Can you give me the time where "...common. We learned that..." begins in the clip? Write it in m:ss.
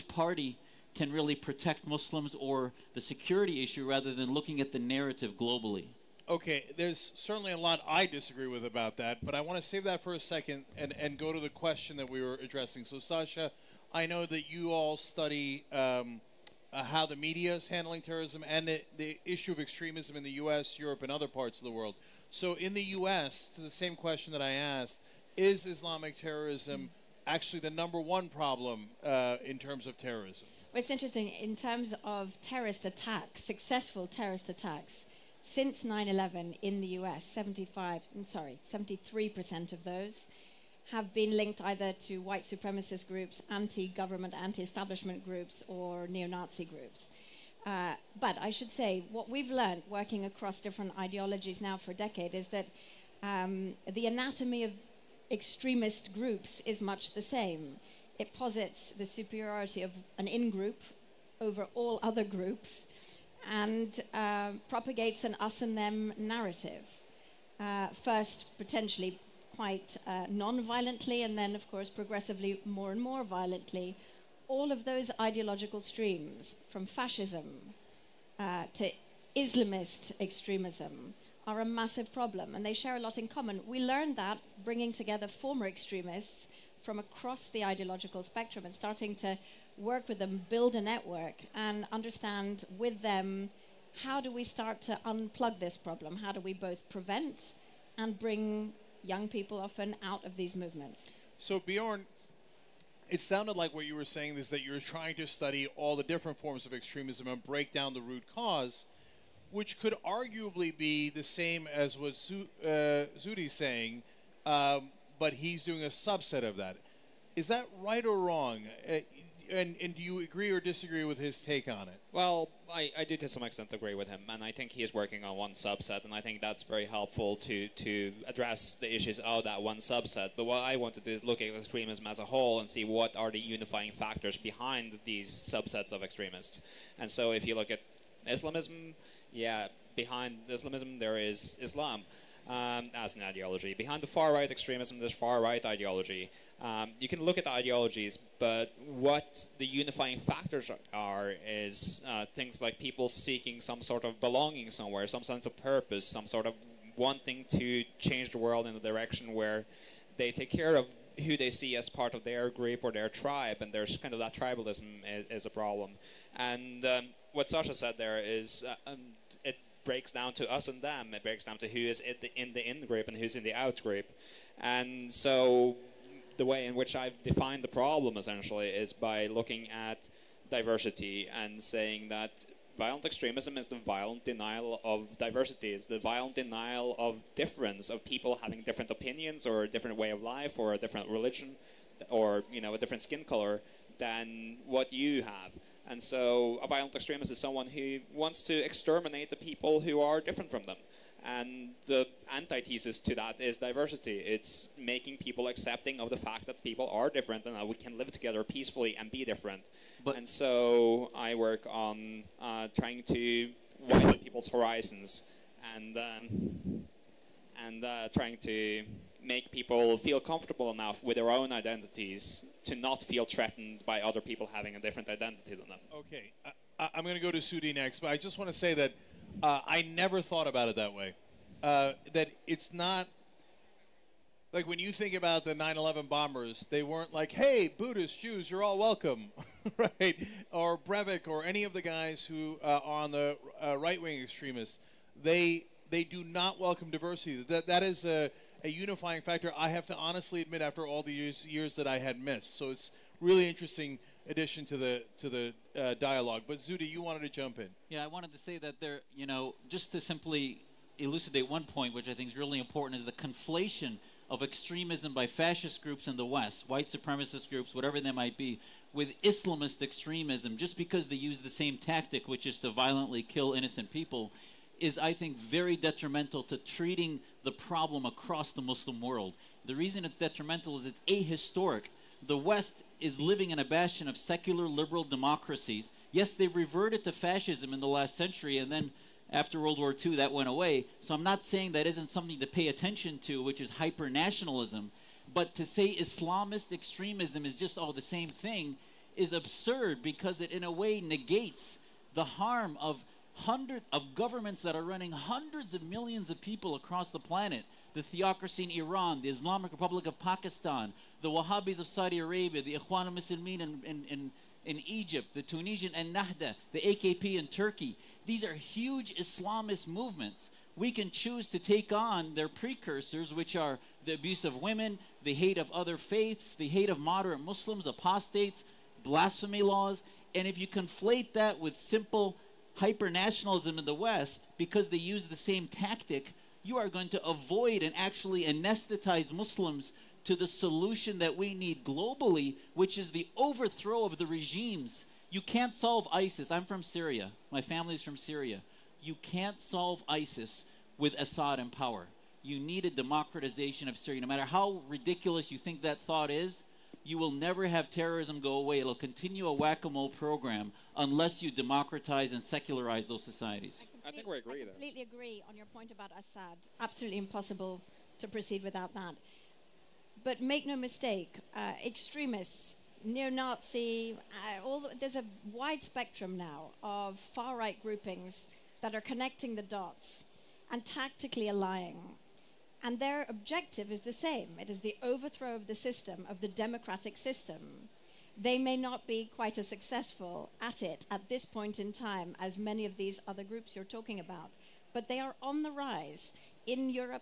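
1:23.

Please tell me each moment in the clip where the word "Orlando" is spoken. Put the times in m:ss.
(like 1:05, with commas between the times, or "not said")
not said.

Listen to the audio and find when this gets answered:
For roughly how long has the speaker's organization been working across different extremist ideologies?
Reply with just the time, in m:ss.
0:51.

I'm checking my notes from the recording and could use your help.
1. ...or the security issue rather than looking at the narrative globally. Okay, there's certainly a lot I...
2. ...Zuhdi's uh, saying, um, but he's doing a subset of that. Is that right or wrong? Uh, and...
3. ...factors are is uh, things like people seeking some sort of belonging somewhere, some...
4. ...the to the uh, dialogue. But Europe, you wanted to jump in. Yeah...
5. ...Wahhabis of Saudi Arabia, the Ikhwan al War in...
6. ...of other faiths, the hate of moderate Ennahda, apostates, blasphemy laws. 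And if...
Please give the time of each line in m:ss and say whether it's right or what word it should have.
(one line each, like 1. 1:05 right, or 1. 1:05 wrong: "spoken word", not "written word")
1. 0:02 right
2. 1:53 right
3. 2:30 right
4. 4:14 wrong: "Zuhdi", not "Europe"
5. 5:11 wrong: "Muslimin", not "War"
6. 5:25 wrong: "Muslims", not "Ennahda".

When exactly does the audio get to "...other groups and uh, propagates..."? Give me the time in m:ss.
1:02.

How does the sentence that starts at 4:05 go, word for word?
They they do not welcome diversity.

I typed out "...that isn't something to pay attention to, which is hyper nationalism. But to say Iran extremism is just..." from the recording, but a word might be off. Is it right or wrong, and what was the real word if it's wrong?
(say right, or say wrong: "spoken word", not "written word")
wrong: "Islamist", not "Iran".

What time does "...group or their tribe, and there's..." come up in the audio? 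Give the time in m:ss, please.
2:42.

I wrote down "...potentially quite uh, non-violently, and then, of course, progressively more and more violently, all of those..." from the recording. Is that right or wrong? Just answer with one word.
right.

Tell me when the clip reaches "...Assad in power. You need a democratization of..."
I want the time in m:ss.
5:51.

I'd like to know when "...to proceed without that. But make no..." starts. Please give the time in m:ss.
6:08.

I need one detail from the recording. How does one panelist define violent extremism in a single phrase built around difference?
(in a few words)
the violent denial of diversity.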